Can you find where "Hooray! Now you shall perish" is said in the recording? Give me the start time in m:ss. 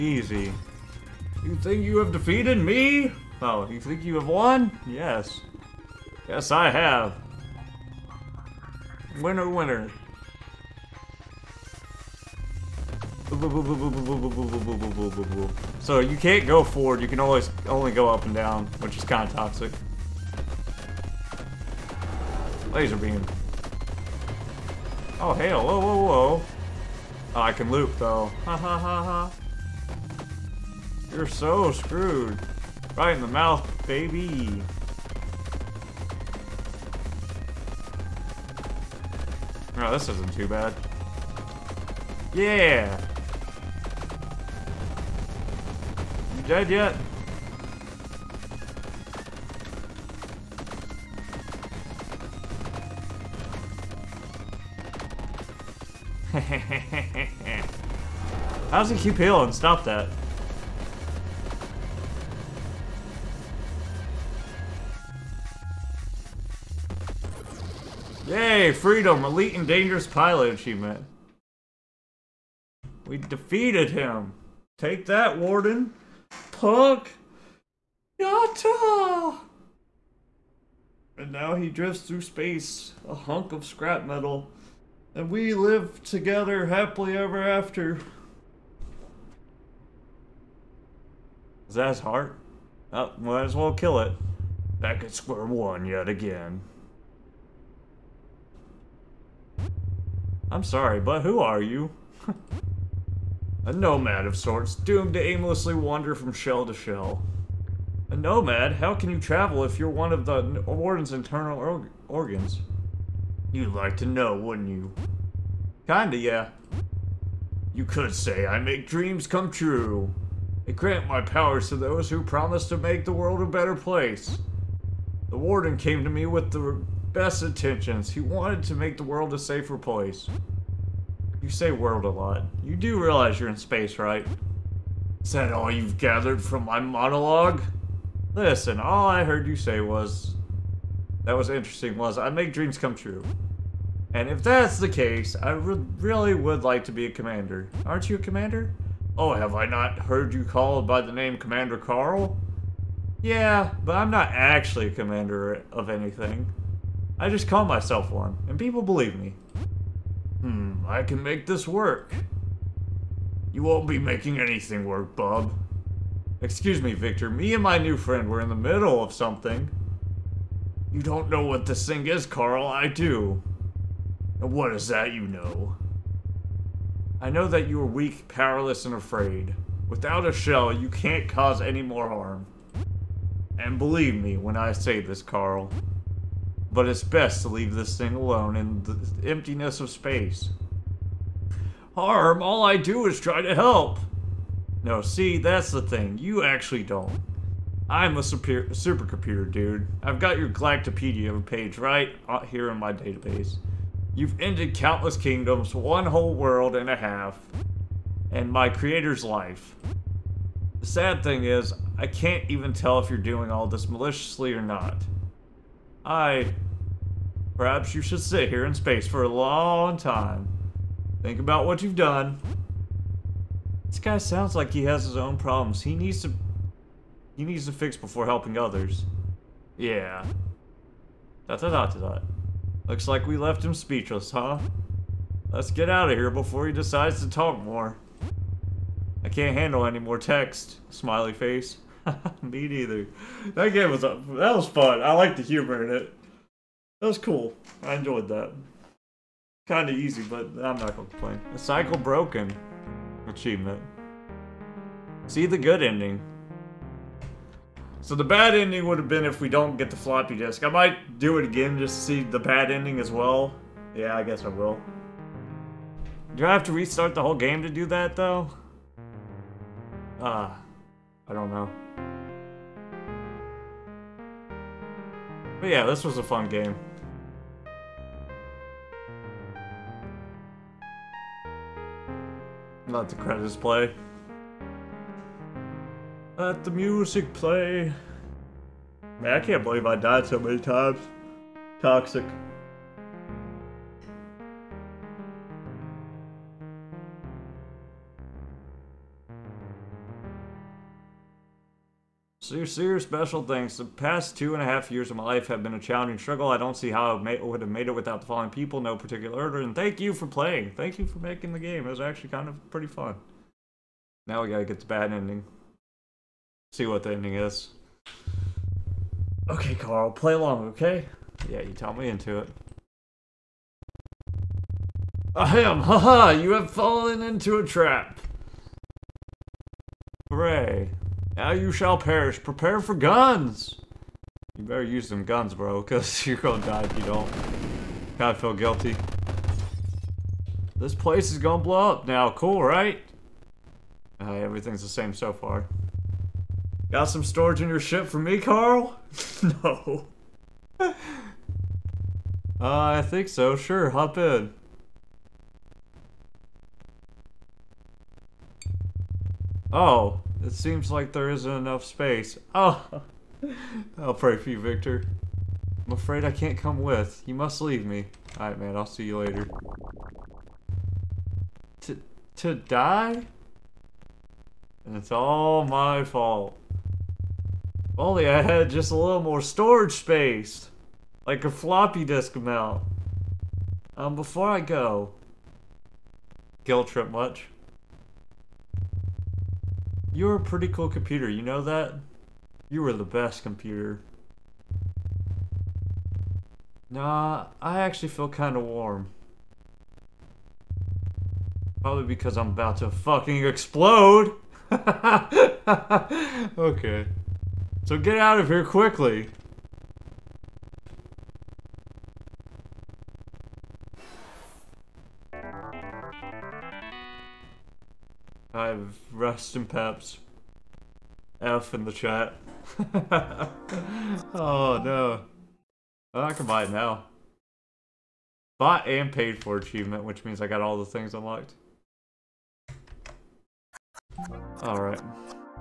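5:30.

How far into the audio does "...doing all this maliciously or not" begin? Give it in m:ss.
3:33.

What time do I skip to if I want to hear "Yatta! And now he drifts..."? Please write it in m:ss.
1:18.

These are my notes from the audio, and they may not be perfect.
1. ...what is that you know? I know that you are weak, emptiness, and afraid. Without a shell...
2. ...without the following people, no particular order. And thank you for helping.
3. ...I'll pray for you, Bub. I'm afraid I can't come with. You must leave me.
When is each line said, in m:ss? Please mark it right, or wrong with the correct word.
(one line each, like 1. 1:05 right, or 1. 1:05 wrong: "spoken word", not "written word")
1. 2:54 wrong: "powerless", not "emptiness"
2. 5:07 wrong: "playing", not "helping"
3. 6:03 wrong: "Victor", not "Bub".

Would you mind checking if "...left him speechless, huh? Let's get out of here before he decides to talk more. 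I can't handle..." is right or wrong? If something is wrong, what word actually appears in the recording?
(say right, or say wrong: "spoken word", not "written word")
right.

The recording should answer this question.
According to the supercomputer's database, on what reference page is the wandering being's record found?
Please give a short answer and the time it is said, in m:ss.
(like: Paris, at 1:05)
Galactopedia, at 3:20.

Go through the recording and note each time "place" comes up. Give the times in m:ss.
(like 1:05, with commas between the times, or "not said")
2:03, 2:09, 5:40.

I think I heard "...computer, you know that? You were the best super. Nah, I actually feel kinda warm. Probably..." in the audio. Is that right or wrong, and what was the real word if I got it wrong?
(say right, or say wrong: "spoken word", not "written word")
wrong: "computer", not "super".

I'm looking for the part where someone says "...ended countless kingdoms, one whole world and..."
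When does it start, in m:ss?
3:24.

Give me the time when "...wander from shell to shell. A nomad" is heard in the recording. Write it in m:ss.
1:45.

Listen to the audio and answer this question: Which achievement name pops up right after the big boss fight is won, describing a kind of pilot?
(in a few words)
Elite and dangerous pilot.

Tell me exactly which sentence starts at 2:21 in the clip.
That was interesting was, I make dreams come true.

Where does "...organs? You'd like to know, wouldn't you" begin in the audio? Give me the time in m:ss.
1:52.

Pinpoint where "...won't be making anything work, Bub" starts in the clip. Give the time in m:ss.
2:43.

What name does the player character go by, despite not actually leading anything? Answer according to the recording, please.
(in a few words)
Commander Carl.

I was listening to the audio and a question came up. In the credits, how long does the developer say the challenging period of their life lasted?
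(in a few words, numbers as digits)
2 and a half years.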